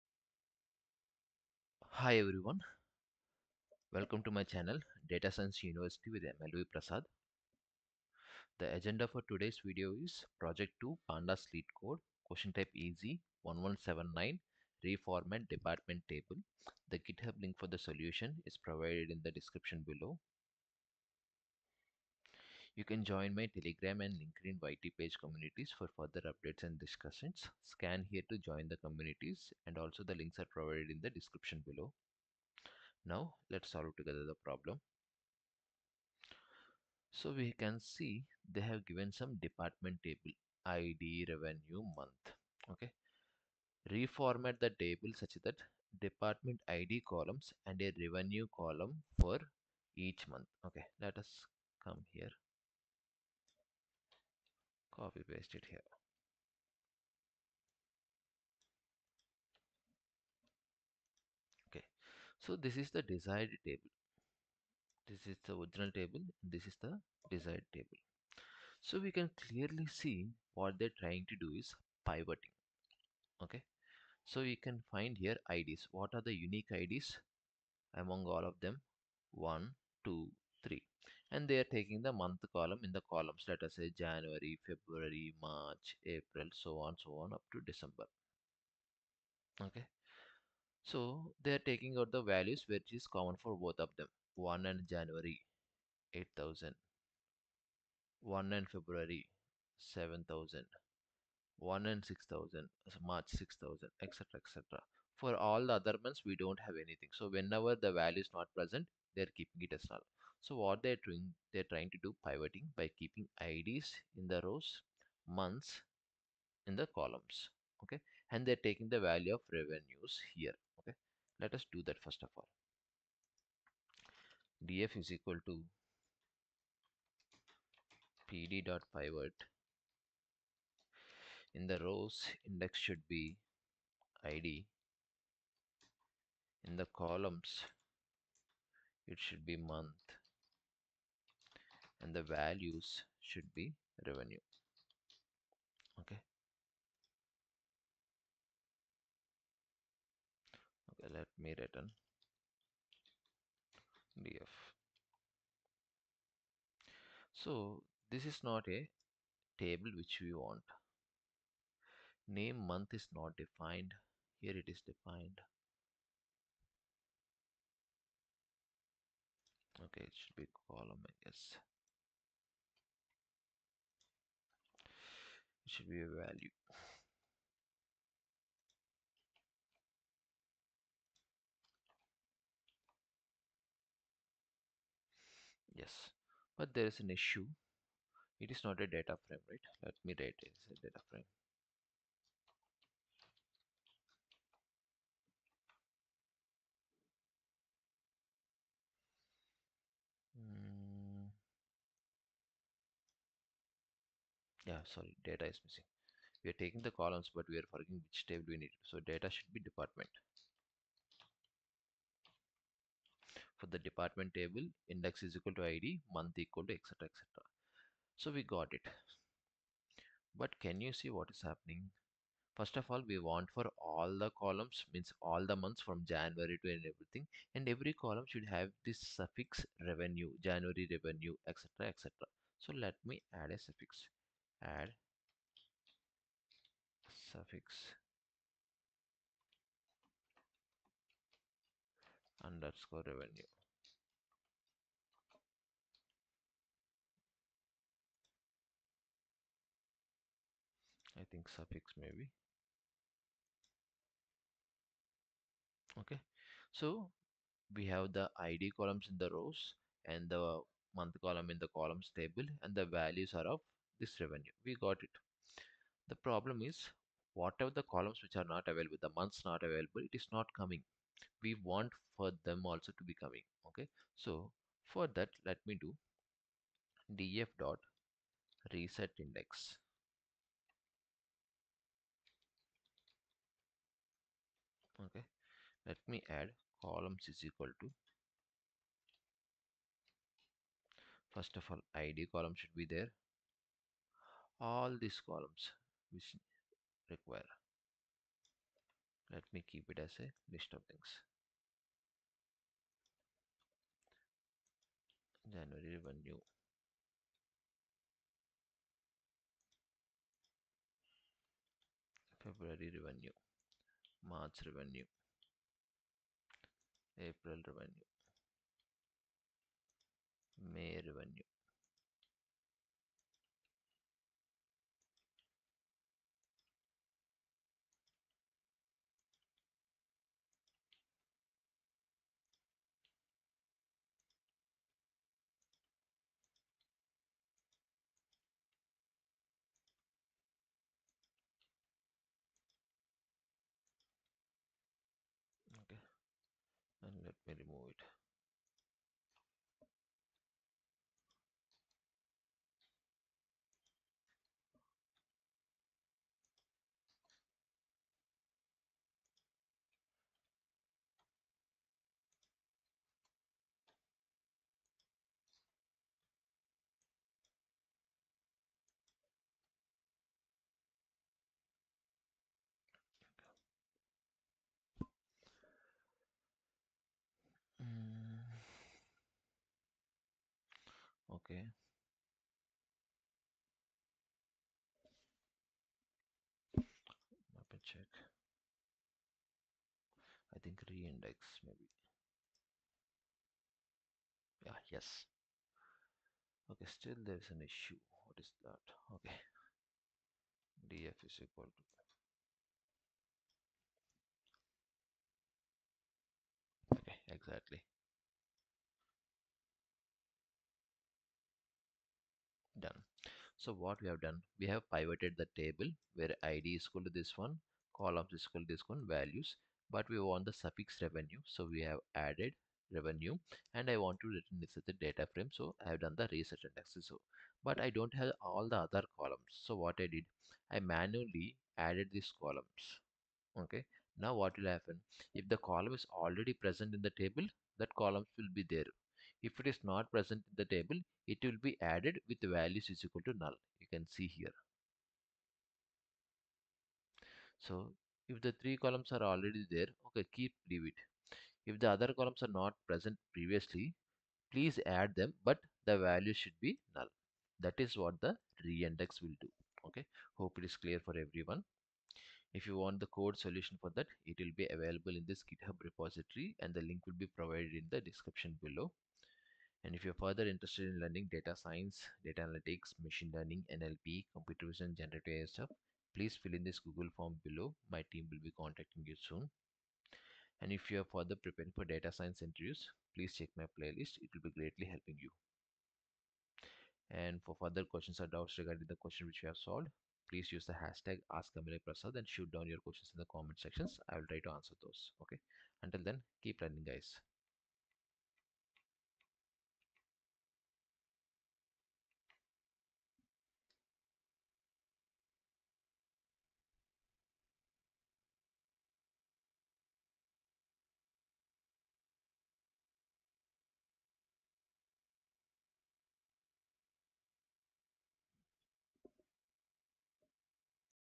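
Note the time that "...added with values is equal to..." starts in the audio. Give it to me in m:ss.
7:21.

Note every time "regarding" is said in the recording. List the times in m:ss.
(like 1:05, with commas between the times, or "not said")
8:08.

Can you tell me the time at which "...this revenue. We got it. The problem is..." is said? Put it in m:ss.
4:24.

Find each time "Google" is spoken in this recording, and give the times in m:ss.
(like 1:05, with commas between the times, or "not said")
7:56.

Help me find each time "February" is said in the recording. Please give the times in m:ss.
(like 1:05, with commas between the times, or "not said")
1:24, 1:38, 5:12.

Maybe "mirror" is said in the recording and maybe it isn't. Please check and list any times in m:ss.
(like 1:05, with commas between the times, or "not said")
not said.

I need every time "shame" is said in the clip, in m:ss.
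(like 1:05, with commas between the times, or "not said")
not said.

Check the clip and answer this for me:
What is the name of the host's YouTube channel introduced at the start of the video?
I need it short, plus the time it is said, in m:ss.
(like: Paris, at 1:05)
Data Science University, at 0:05.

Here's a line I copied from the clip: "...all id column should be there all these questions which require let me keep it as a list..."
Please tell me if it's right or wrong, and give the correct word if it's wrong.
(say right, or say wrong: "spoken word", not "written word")
wrong: "columns", not "questions".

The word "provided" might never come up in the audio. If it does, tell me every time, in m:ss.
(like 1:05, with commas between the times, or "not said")
0:18, 0:30, 7:47.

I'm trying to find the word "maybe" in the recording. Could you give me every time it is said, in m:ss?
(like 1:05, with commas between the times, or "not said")
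4:11, 6:31.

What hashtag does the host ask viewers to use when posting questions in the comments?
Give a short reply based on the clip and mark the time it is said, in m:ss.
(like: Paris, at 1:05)
#AskAmilay, at 8:11.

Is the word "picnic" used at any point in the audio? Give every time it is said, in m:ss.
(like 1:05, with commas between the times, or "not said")
not said.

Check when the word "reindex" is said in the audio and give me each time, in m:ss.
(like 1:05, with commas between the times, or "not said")
6:30, 7:38.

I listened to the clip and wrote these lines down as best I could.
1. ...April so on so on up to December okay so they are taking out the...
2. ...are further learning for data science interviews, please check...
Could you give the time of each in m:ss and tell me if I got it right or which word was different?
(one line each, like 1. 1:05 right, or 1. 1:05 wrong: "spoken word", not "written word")
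1. 1:26 right
2. 8:01 wrong: "preparing", not "learning".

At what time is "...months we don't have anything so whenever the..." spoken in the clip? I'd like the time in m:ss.
1:46.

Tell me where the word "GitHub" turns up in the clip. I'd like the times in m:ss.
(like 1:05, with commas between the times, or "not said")
0:16, 7:45.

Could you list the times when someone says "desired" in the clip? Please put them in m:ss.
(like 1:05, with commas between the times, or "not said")
1:03, 1:07.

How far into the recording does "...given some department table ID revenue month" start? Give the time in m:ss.
0:38.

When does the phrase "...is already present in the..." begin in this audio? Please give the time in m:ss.
7:15.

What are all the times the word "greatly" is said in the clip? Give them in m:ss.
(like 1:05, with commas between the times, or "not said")
8:04.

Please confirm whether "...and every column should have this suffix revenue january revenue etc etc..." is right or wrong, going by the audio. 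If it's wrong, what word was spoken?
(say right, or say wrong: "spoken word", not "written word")
right.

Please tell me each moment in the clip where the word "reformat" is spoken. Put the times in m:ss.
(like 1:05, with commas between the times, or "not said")
0:14, 0:43.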